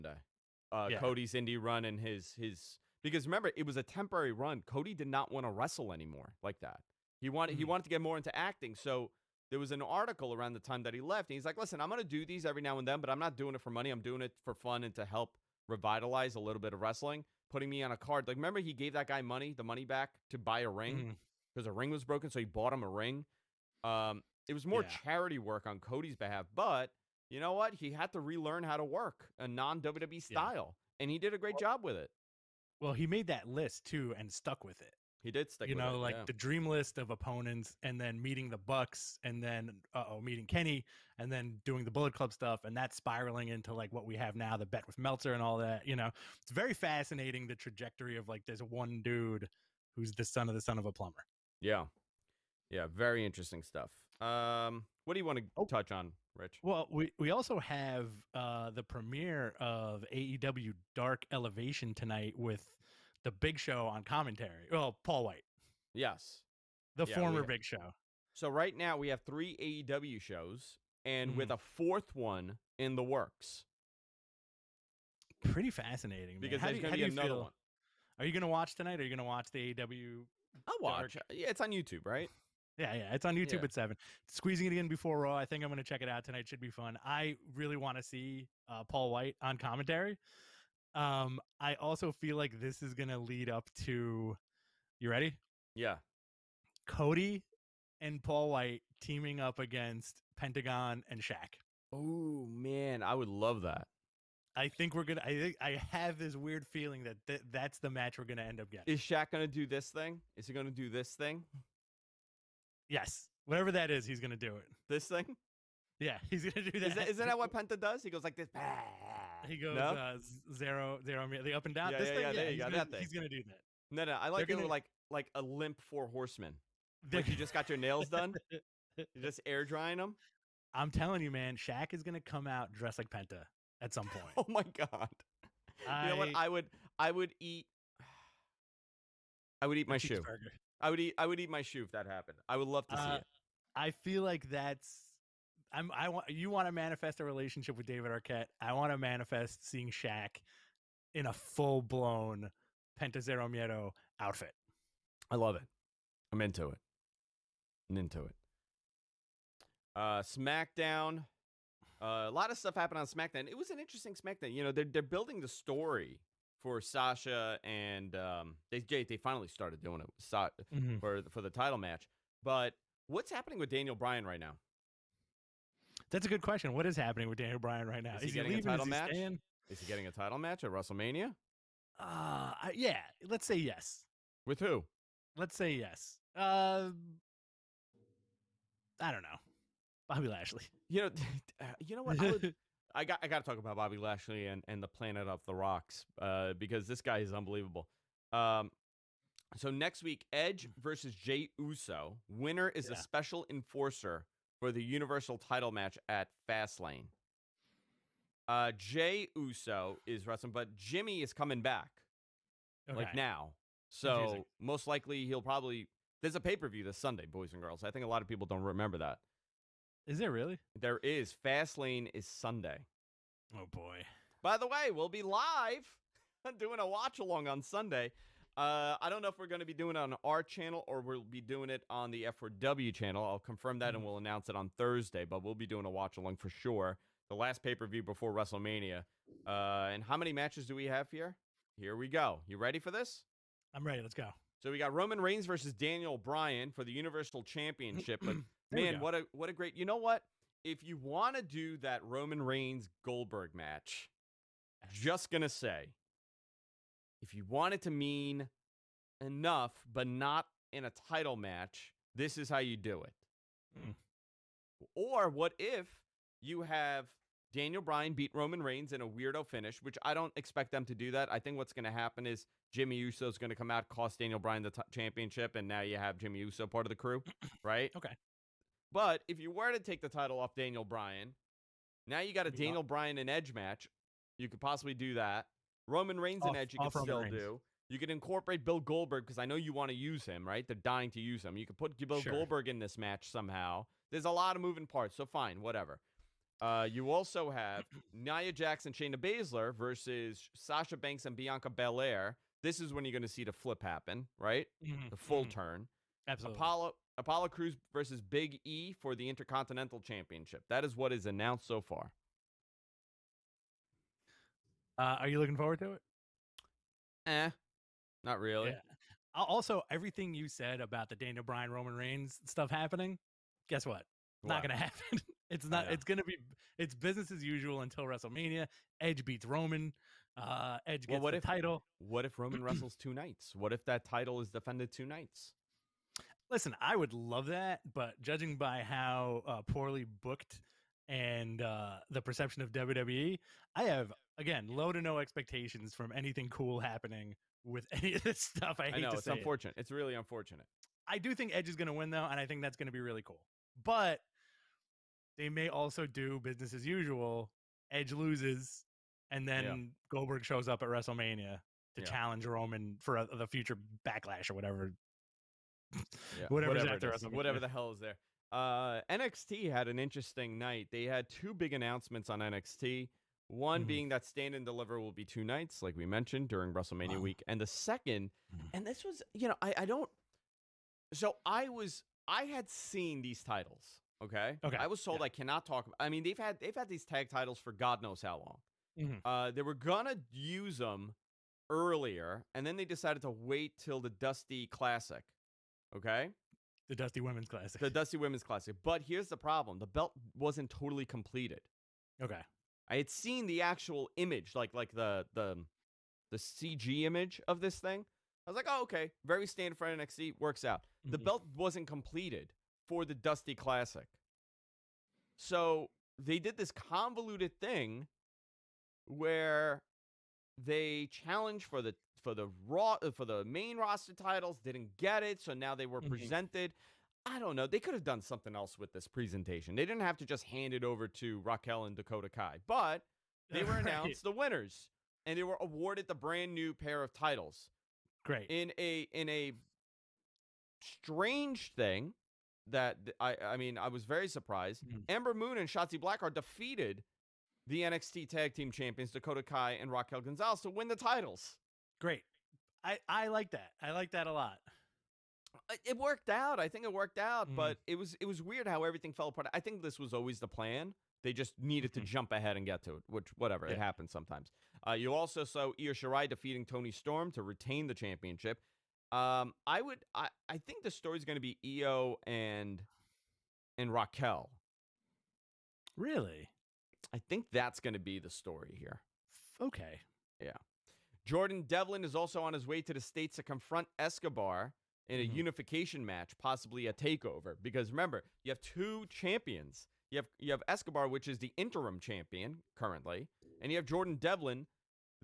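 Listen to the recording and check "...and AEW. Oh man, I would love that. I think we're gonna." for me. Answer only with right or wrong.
wrong.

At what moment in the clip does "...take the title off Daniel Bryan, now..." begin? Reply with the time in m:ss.
4:39.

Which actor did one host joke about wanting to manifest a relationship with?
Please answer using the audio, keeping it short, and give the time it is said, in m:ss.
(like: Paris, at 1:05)
David Arquette, at 2:27.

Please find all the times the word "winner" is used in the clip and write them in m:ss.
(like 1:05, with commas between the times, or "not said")
3:22, 7:14.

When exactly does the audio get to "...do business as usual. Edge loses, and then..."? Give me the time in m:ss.
5:56.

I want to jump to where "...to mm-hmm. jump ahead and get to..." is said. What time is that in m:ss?
7:41.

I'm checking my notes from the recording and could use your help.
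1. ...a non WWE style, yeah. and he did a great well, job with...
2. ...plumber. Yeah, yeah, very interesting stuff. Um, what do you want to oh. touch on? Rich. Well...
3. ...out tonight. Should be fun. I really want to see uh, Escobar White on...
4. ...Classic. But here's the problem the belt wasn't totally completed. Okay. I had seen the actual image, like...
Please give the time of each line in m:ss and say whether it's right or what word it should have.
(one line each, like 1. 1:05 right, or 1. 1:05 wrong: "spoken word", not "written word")
1. 0:29 right
2. 0:50 right
3. 1:26 wrong: "Paul", not "Escobar"
4. 6:38 right.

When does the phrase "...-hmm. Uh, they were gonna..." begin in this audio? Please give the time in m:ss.
6:29.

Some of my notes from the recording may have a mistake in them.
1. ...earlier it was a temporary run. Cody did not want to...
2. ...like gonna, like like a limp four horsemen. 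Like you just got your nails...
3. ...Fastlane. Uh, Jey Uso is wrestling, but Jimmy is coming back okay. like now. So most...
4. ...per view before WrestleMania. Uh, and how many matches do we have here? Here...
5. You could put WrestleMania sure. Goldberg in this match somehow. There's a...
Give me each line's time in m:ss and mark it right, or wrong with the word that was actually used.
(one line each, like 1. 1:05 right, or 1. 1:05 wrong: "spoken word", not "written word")
1. 0:03 wrong: "remember", not "earlier"
2. 2:04 right
3. 3:26 right
4. 3:57 right
5. 4:51 wrong: "Bill", not "WrestleMania".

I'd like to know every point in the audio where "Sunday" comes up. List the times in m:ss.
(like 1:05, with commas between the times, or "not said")
3:36, 3:42, 3:47.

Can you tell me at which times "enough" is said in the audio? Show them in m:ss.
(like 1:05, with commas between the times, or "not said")
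4:19.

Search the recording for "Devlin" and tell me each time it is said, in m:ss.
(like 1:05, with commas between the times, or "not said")
8:01, 8:14.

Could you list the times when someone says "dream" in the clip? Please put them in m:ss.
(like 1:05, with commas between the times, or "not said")
0:36.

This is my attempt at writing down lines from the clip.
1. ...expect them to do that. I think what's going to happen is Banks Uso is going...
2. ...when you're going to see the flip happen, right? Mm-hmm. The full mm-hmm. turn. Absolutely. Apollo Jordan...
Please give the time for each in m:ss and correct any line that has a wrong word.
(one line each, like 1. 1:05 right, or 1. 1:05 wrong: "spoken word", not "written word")
1. 4:30 wrong: "Jimmy", not "Banks"
2. 5:02 wrong: "Apollo", not "Jordan".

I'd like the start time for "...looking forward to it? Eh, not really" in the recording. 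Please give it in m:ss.
5:15.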